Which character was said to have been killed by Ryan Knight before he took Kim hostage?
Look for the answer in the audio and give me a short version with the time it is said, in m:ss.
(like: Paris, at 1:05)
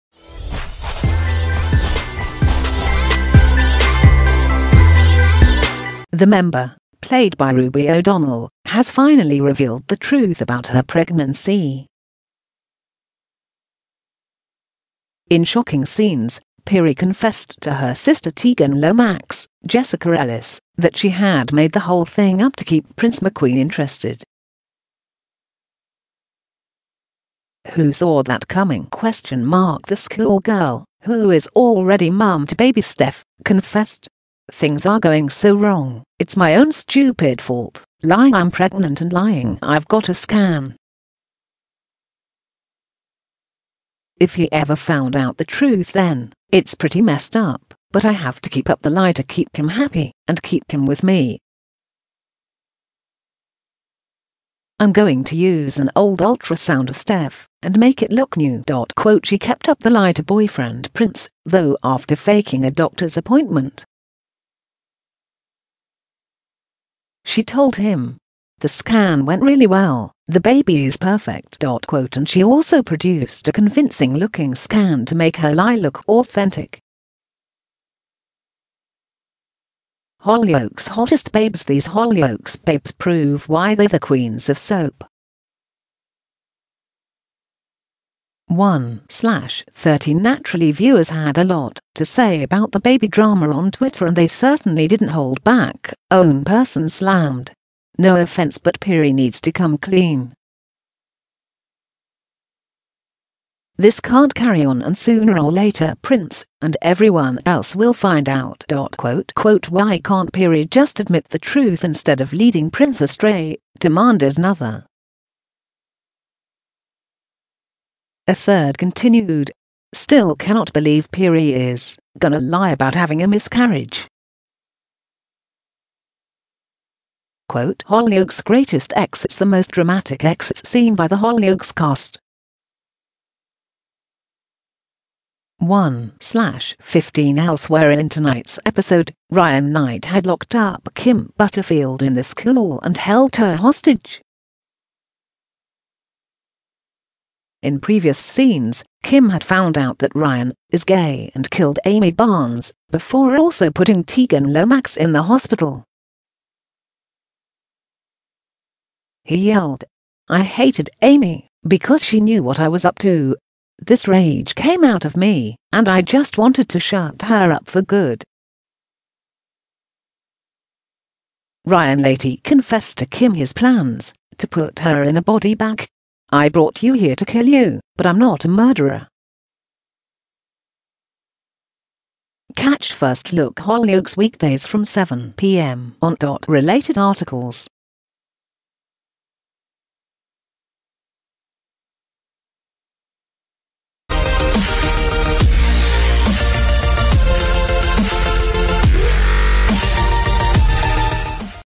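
Amy Barnes, at 2:31.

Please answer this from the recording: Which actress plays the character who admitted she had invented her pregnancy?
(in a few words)
Ruby O'Donnell.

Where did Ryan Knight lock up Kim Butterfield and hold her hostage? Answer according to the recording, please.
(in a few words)
The school.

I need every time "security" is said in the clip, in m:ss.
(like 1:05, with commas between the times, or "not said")
not said.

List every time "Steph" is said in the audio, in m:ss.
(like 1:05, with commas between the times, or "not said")
0:32, 0:56.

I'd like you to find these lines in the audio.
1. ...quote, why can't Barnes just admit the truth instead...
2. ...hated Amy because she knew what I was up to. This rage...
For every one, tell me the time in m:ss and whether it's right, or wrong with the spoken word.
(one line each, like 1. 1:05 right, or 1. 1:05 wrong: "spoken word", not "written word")
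1. 1:49 wrong: "Peri", not "Barnes"
2. 2:40 right.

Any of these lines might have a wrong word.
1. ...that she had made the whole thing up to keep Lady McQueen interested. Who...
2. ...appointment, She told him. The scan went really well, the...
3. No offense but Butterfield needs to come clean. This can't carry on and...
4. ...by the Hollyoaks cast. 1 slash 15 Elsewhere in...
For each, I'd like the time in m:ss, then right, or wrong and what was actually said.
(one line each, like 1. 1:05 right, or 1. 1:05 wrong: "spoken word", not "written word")
1. 0:20 wrong: "Prince", not "Lady"
2. 1:03 right
3. 1:37 wrong: "Peri", not "Butterfield"
4. 2:10 right.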